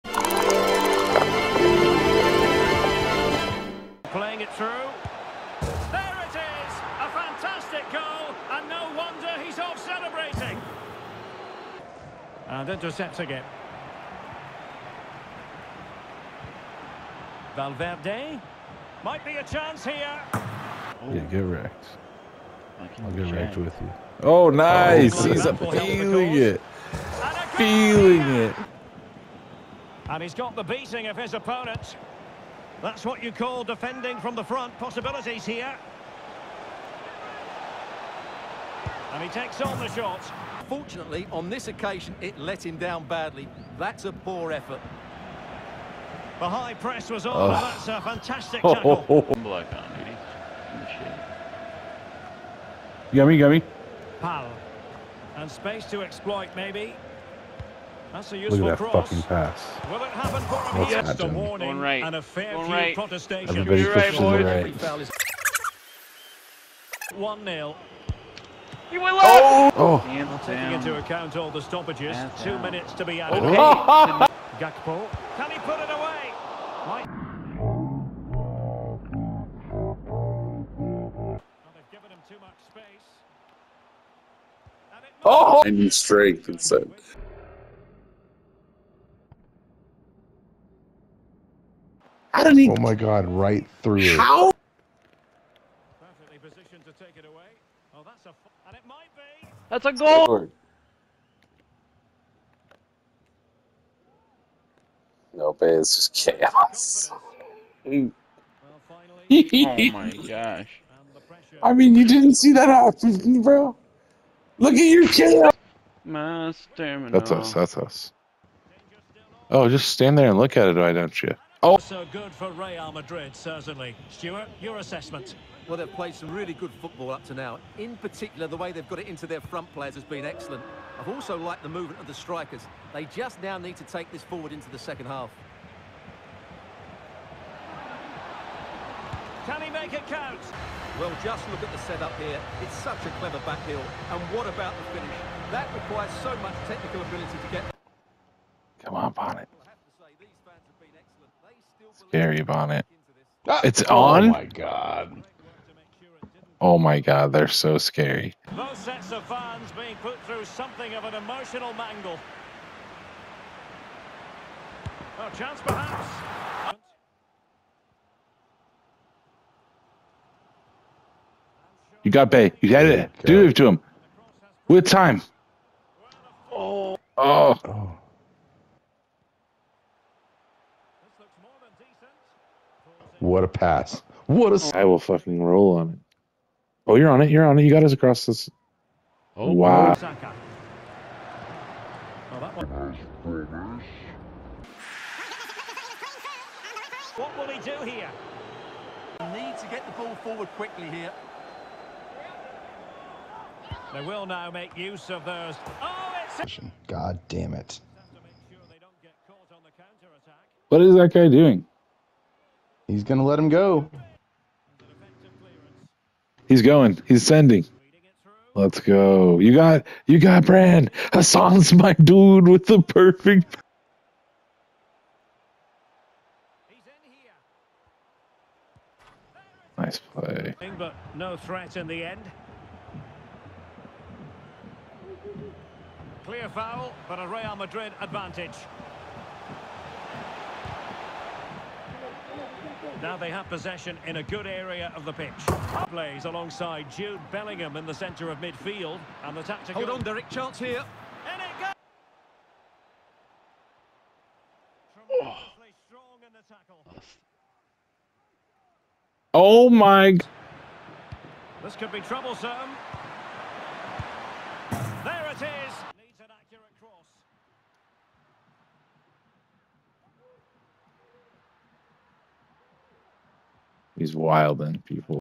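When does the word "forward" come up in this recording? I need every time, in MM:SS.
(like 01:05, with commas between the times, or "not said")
02:14, 03:20.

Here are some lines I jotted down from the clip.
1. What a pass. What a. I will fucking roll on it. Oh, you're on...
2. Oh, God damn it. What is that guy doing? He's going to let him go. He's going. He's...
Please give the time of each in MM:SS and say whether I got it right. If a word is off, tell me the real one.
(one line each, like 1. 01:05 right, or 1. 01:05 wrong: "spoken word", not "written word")
1. 03:03 right
2. 03:25 right.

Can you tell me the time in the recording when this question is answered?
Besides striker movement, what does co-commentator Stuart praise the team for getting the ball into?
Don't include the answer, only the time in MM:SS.
02:09.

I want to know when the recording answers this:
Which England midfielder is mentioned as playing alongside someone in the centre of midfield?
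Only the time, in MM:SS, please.
04:06.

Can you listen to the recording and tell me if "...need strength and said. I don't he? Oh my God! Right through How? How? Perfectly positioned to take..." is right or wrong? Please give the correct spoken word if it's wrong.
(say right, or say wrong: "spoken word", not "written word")
right.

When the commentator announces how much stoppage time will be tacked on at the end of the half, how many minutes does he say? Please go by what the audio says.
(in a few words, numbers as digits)
2.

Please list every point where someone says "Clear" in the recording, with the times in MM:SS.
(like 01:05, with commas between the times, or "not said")
03:56.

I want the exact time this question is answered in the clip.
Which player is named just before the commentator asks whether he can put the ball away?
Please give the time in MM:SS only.
01:14.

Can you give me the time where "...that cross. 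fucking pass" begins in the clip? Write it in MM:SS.
00:58.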